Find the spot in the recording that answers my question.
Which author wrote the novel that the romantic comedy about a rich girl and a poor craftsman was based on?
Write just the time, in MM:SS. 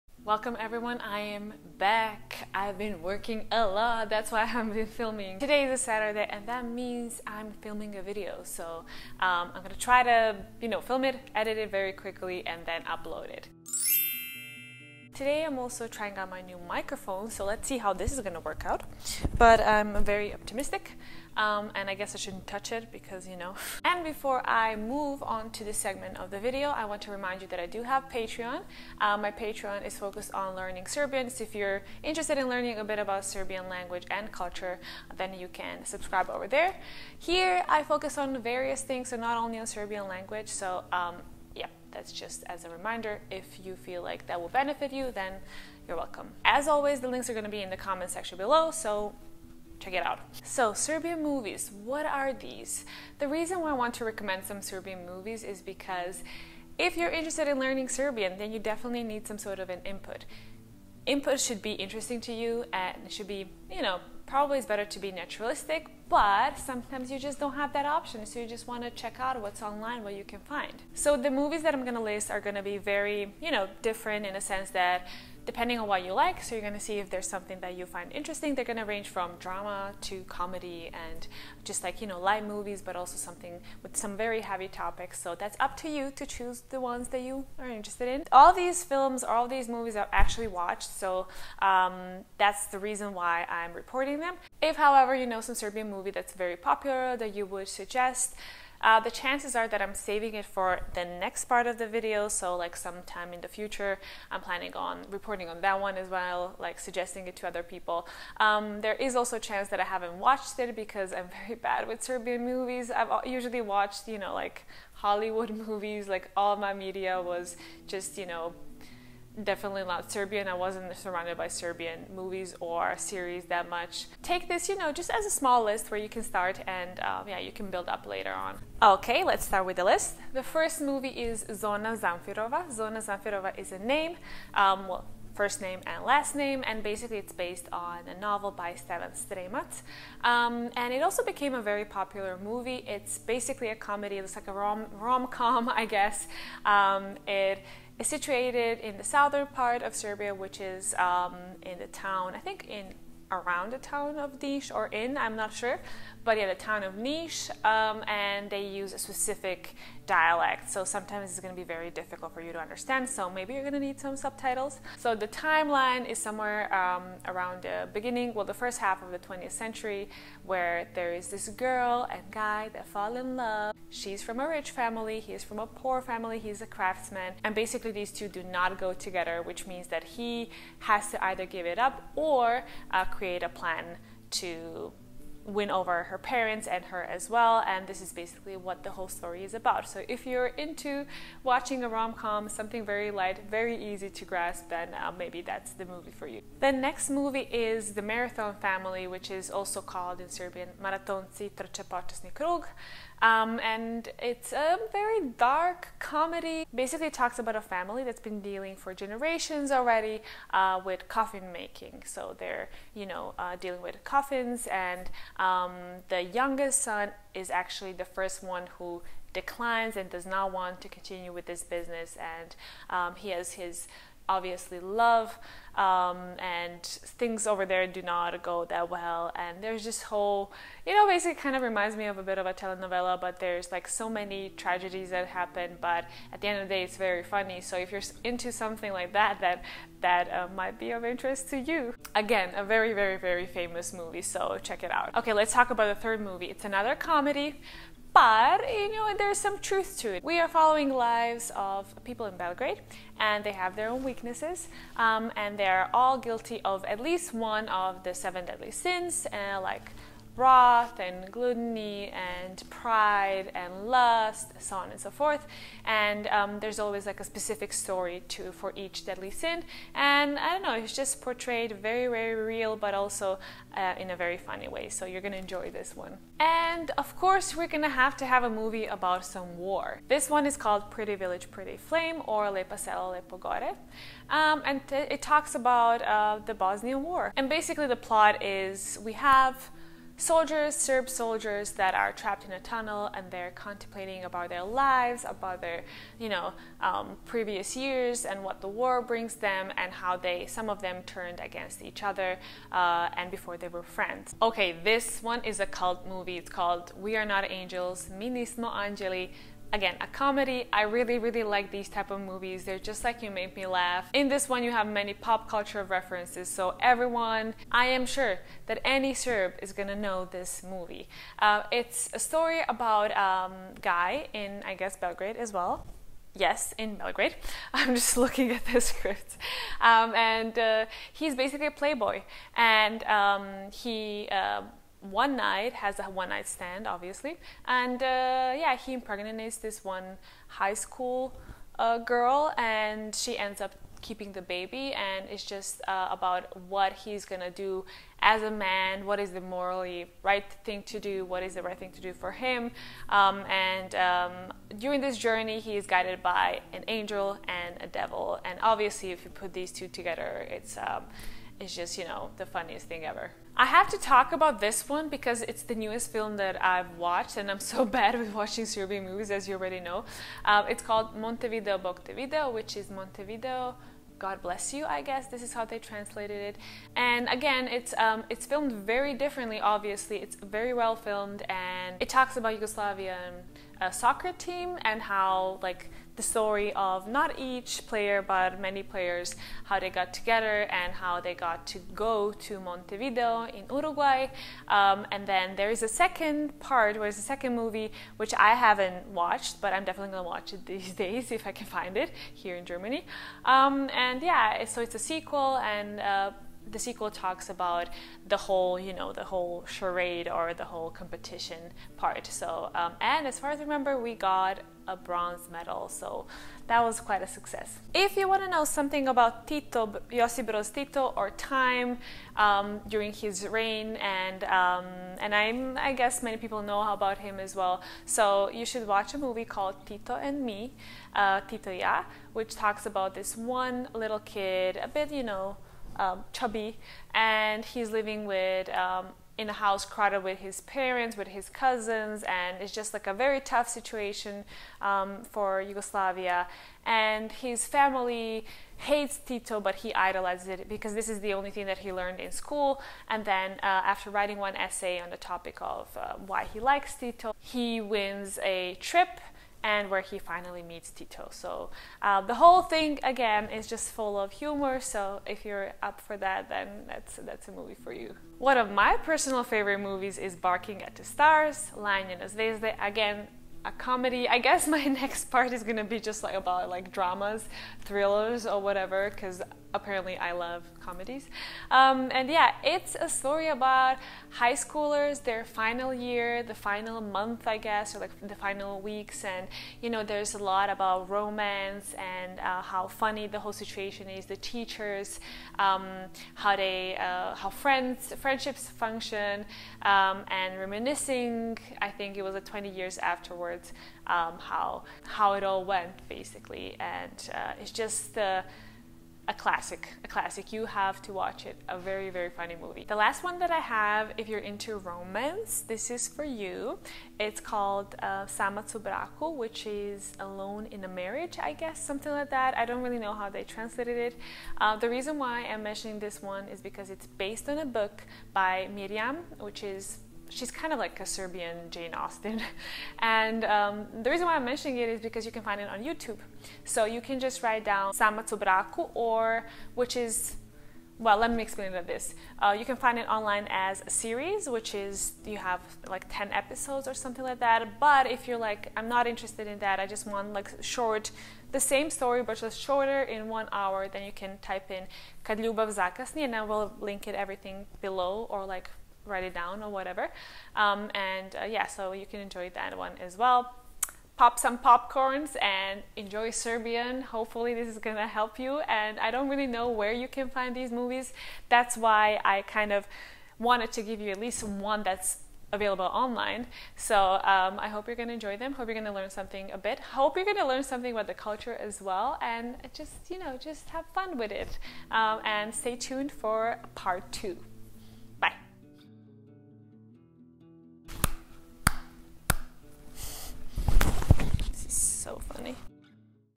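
02:18.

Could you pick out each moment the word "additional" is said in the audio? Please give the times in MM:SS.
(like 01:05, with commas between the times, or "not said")
not said.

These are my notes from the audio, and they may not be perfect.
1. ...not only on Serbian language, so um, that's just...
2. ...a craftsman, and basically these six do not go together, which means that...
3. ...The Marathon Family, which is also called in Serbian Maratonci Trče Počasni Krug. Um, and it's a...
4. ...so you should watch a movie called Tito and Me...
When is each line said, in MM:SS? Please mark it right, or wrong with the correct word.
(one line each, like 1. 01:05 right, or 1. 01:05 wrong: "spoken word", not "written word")
1. 00:39 right
2. 02:56 wrong: "two", not "six"
3. 03:17 right
4. 07:08 right.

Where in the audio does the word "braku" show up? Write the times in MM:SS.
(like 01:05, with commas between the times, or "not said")
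08:38, 08:58.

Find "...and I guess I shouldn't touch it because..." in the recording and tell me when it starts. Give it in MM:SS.
00:21.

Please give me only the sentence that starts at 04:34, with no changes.
So you're gonna enjoy this one.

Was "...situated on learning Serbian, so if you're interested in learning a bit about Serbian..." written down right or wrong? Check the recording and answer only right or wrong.
wrong.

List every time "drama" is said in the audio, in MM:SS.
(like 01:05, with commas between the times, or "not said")
01:19, 07:56.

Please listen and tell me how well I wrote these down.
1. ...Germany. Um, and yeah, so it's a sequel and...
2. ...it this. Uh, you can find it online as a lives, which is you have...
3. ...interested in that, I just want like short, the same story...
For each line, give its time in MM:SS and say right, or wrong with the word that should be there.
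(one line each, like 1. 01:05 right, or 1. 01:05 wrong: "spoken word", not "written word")
1. 06:42 right
2. 09:01 wrong: "series", not "lives"
3. 09:09 right.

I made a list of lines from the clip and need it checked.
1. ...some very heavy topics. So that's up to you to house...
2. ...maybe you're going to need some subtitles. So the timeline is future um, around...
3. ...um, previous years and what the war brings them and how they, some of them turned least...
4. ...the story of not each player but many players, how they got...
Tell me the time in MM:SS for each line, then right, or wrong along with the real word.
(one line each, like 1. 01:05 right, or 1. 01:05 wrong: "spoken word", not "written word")
1. 01:23 wrong: "choose", not "house"
2. 02:43 wrong: "somewhere", not "future"
3. 04:56 wrong: "against", not "least"
4. 06:26 right.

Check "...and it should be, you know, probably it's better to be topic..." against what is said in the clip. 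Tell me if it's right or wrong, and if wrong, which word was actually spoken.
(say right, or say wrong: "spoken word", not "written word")
wrong: "naturalistic", not "topic".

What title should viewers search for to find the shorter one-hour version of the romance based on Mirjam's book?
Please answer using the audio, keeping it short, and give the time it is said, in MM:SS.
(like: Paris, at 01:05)
Kad ljubav zakasni, at 09:15.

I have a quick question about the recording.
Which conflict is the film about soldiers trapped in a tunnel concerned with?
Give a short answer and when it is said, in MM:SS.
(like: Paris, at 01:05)
The Bosnian War, at 04:46.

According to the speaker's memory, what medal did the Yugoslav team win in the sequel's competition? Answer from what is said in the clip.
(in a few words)
Bronze medal.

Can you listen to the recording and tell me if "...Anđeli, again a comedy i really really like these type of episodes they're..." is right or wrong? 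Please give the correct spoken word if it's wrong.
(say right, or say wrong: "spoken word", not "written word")
wrong: "movies", not "episodes".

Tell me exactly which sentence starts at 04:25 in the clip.
And um, there's always like a specific story to for each deadly sin.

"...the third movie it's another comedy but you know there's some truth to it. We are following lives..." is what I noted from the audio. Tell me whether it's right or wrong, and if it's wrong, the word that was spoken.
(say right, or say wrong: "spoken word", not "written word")
right.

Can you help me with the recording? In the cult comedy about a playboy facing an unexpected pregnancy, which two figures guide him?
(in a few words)
An angel and a devil.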